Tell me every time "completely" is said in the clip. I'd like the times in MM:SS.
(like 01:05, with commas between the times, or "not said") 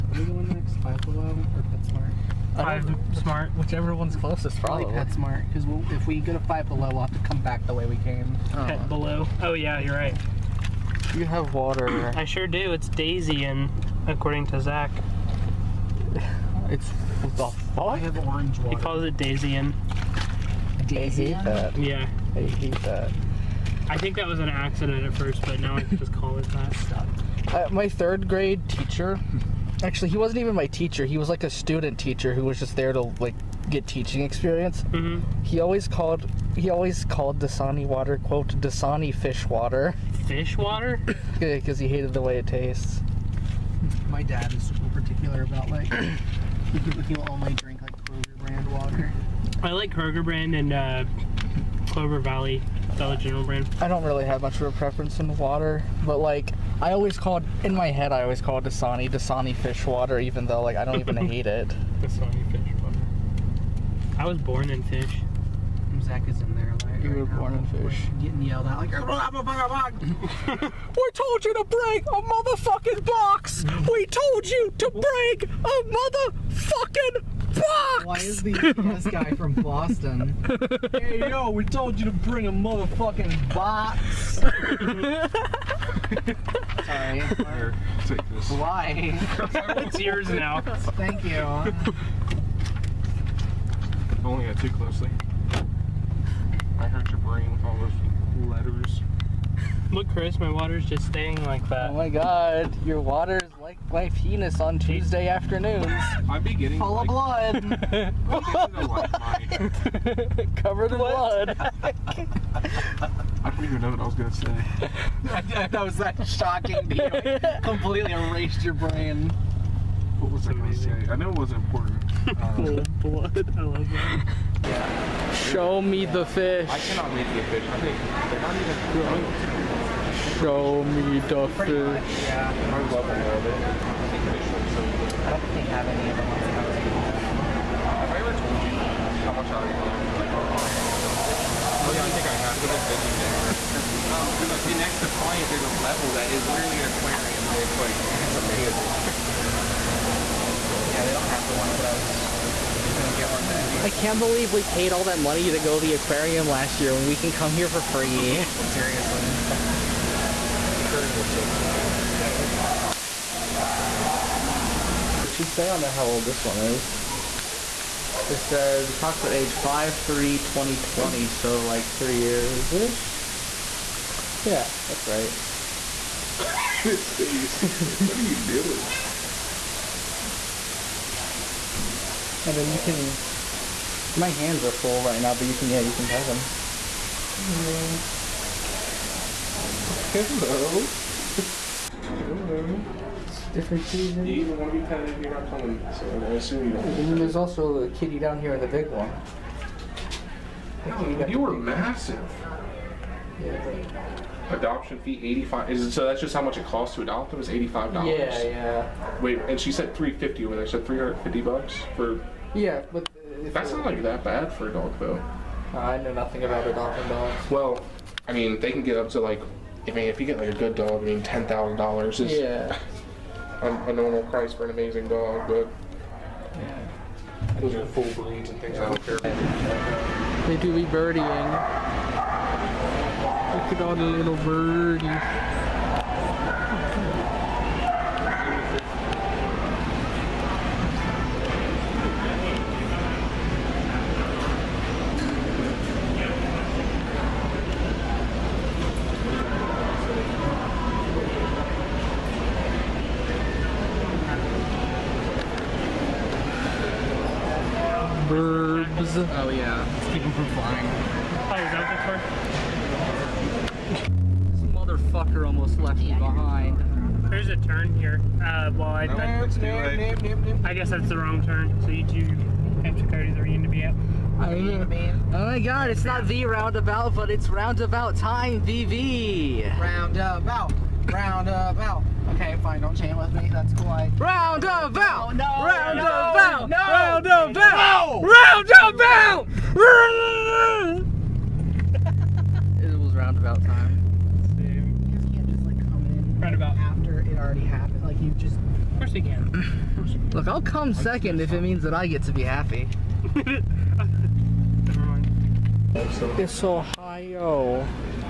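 01:57.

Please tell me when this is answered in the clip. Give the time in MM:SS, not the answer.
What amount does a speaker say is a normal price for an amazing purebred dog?
03:41.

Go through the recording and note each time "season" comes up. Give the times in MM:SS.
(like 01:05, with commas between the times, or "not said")
03:13.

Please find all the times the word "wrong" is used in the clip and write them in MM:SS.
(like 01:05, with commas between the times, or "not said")
04:31.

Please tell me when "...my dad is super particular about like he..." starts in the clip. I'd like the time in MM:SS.
00:44.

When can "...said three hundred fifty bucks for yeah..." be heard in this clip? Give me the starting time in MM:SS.
03:30.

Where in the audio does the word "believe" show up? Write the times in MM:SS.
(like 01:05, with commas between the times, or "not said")
02:34.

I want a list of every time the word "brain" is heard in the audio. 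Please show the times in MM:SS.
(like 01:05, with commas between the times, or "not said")
01:37, 01:58.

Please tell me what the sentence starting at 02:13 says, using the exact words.
I don't think they have any of them.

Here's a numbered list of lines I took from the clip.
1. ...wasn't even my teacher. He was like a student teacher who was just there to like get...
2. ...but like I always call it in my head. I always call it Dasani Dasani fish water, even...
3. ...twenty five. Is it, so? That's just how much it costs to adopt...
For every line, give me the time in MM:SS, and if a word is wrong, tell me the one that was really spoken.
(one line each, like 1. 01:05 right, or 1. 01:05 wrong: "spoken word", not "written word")
1. 00:30 right
2. 00:56 right
3. 03:25 wrong: "eighty", not "twenty".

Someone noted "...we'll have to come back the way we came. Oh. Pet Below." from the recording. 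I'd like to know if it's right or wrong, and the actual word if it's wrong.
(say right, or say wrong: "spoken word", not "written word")
right.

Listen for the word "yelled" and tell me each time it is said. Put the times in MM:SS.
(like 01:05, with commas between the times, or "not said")
01:08.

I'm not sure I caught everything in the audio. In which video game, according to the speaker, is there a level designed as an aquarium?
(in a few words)
Defiant.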